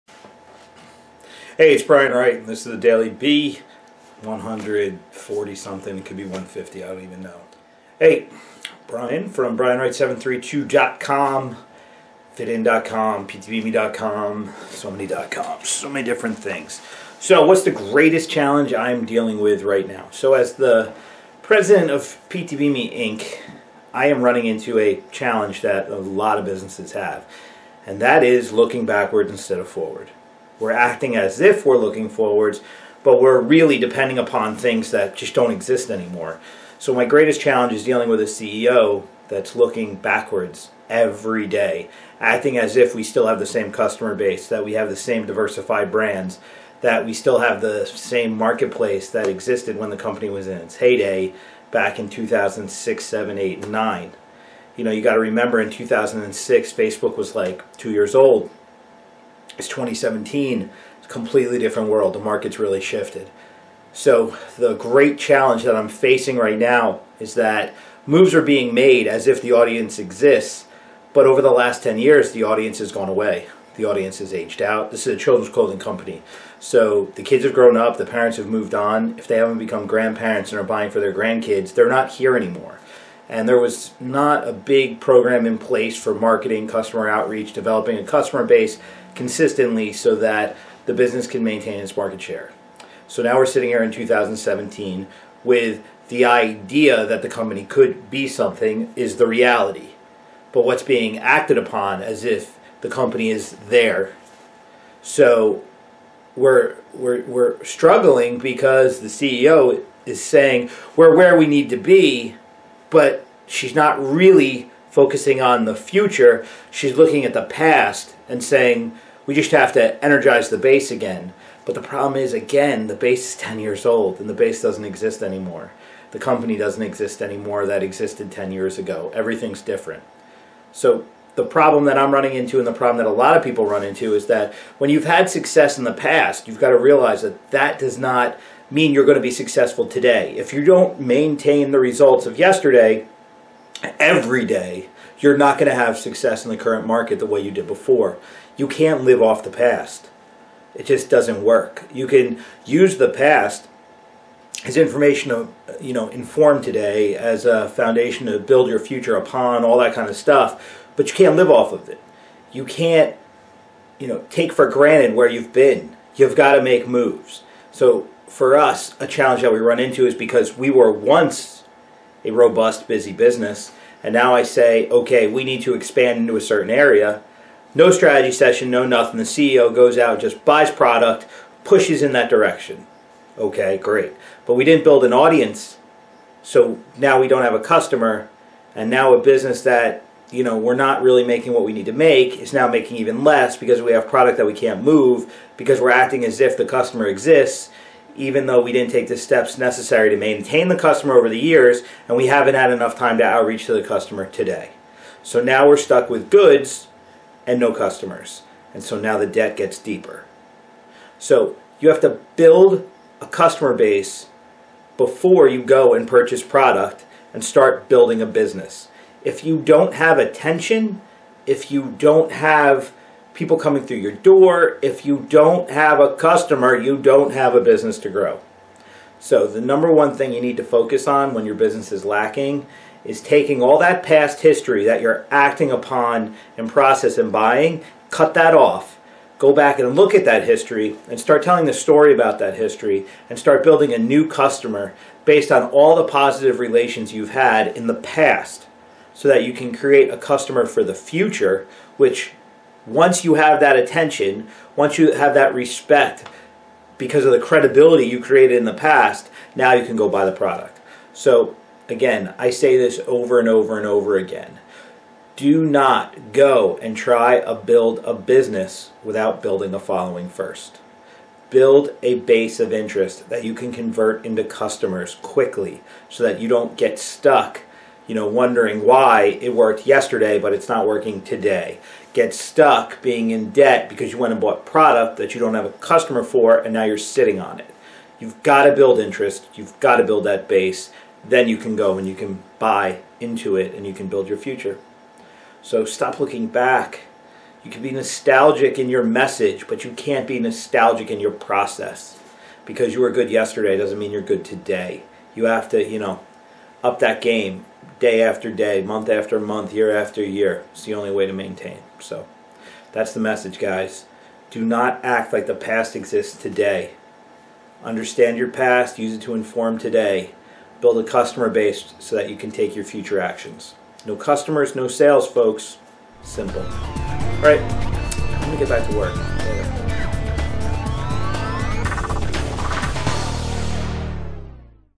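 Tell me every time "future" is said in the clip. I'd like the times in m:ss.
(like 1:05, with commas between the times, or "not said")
1:55, 2:38, 4:10, 4:54, 5:22.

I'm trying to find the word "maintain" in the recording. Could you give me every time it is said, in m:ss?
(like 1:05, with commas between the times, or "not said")
1:31, 2:20, 3:20, 5:11.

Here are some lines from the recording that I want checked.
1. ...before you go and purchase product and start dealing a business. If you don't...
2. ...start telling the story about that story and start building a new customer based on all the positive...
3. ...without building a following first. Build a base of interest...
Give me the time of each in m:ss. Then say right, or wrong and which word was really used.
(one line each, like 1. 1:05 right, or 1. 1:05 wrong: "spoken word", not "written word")
1. 3:34 wrong: "building", not "dealing"
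2. 4:01 wrong: "history", not "story"
3. 4:29 right.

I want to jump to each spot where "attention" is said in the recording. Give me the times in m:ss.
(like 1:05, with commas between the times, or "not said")
3:40, 4:13.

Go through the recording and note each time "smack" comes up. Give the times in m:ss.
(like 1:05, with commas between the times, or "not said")
not said.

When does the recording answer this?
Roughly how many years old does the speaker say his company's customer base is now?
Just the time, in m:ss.
2:03.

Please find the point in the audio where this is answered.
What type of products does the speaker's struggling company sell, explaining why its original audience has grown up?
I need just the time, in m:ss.
1:15.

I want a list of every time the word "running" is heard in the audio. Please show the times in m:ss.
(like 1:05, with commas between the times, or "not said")
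0:24, 2:12.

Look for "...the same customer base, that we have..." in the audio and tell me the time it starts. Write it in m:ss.
0:43.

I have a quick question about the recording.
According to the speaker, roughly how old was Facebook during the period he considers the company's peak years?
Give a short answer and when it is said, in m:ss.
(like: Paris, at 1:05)
2 years old, at 0:57.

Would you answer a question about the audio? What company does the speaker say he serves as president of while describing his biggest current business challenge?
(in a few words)
PTBMe Inc.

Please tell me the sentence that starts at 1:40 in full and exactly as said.
But what's being acted upon as if the company is there.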